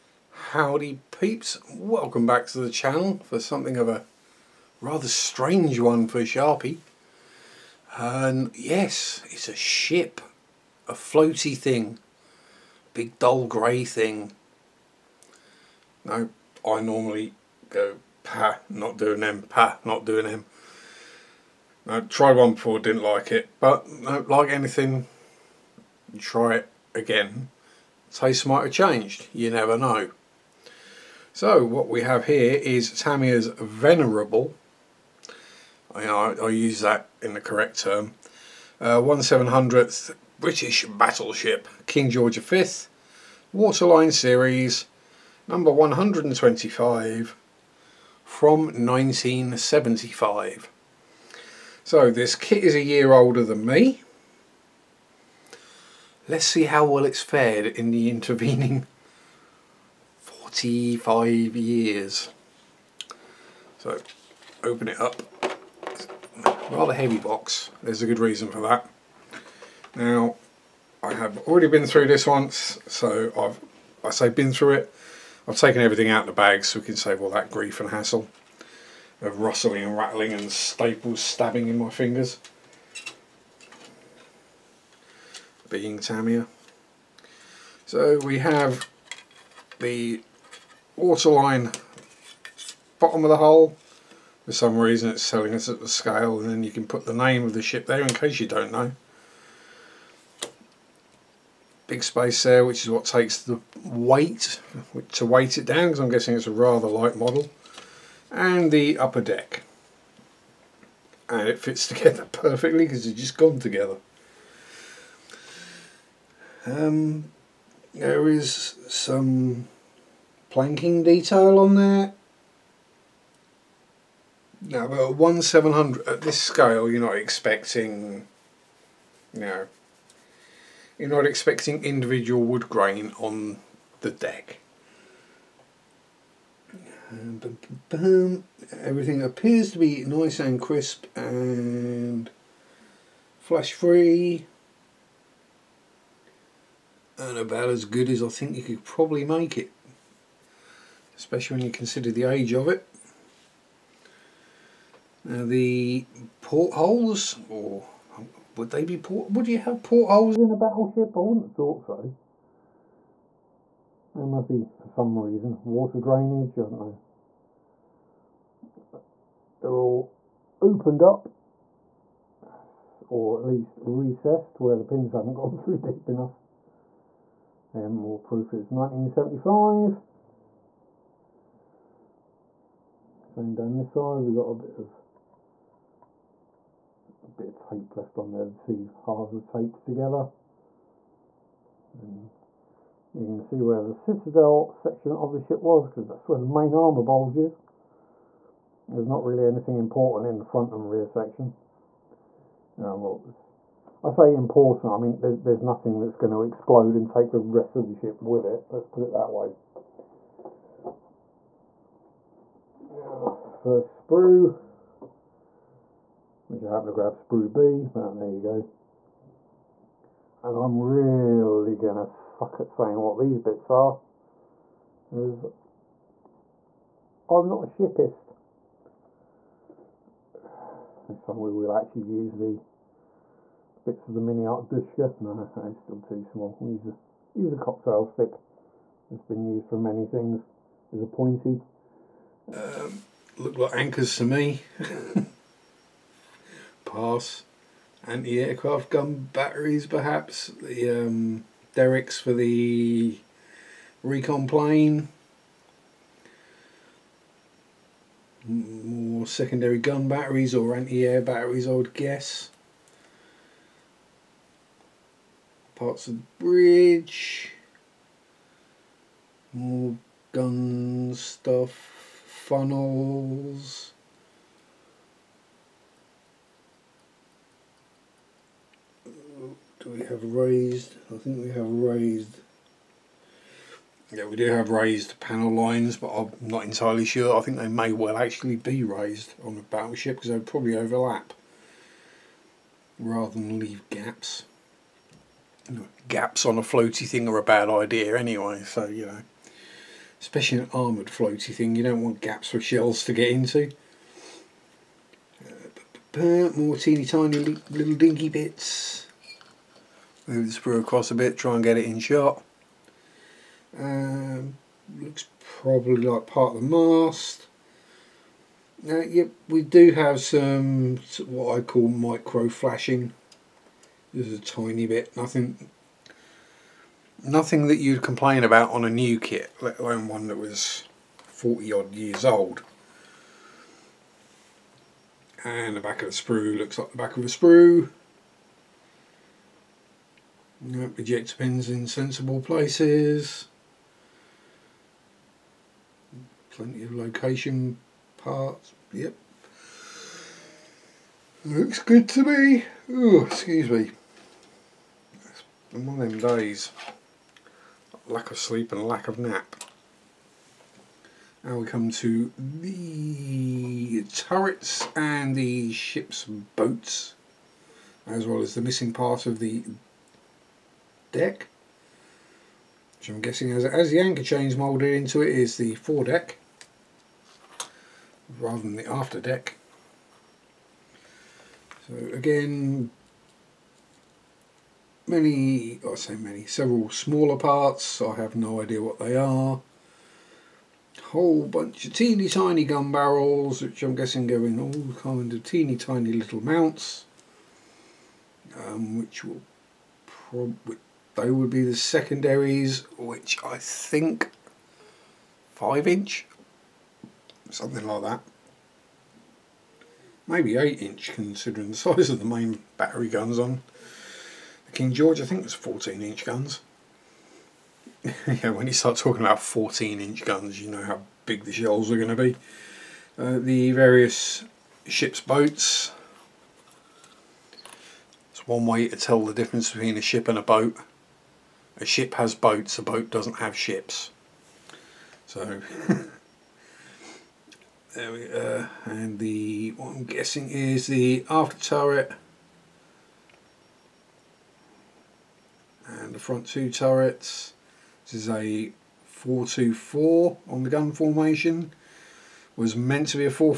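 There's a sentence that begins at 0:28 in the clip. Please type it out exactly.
Taste might have changed, you never know.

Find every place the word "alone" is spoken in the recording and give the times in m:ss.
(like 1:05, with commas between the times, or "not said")
5:29.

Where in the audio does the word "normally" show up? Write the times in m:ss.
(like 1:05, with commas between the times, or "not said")
0:16.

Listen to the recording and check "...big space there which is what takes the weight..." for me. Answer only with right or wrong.
right.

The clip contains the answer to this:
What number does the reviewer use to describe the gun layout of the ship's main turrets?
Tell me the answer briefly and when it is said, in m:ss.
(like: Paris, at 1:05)
424, at 7:29.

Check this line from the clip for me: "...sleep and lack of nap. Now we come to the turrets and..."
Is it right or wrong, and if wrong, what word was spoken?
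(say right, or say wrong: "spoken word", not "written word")
right.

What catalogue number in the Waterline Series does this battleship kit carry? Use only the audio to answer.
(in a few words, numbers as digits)
125.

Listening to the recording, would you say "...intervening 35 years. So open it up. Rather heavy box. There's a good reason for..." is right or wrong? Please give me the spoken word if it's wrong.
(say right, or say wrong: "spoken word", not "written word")
right.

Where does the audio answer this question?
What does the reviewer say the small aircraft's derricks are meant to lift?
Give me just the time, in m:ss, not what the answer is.
4:14.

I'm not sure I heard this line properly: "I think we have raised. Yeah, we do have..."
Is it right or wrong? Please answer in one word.
right.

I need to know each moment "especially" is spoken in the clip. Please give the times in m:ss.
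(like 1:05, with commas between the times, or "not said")
2:31, 5:00.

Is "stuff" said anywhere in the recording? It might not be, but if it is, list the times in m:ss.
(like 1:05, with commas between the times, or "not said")
4:31.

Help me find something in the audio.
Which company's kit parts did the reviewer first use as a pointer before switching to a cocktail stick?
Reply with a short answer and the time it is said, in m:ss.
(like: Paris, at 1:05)
MiniArt, at 3:54.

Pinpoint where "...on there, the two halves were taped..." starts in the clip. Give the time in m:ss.
3:08.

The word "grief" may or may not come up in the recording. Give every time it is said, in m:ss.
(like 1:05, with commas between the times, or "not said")
1:17.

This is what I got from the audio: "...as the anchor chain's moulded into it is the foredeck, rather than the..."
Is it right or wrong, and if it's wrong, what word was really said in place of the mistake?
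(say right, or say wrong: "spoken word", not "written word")
right.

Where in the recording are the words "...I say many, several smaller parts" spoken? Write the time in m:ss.
6:25.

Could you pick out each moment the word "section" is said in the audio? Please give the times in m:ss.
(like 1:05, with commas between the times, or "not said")
3:14, 3:21.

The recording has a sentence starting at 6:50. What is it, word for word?
Maybe eight inch, considering the size of the main battery guns on.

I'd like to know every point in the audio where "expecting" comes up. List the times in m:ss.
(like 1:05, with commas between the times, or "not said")
2:07, 2:11.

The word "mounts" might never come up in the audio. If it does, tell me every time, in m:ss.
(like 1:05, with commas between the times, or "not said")
6:36.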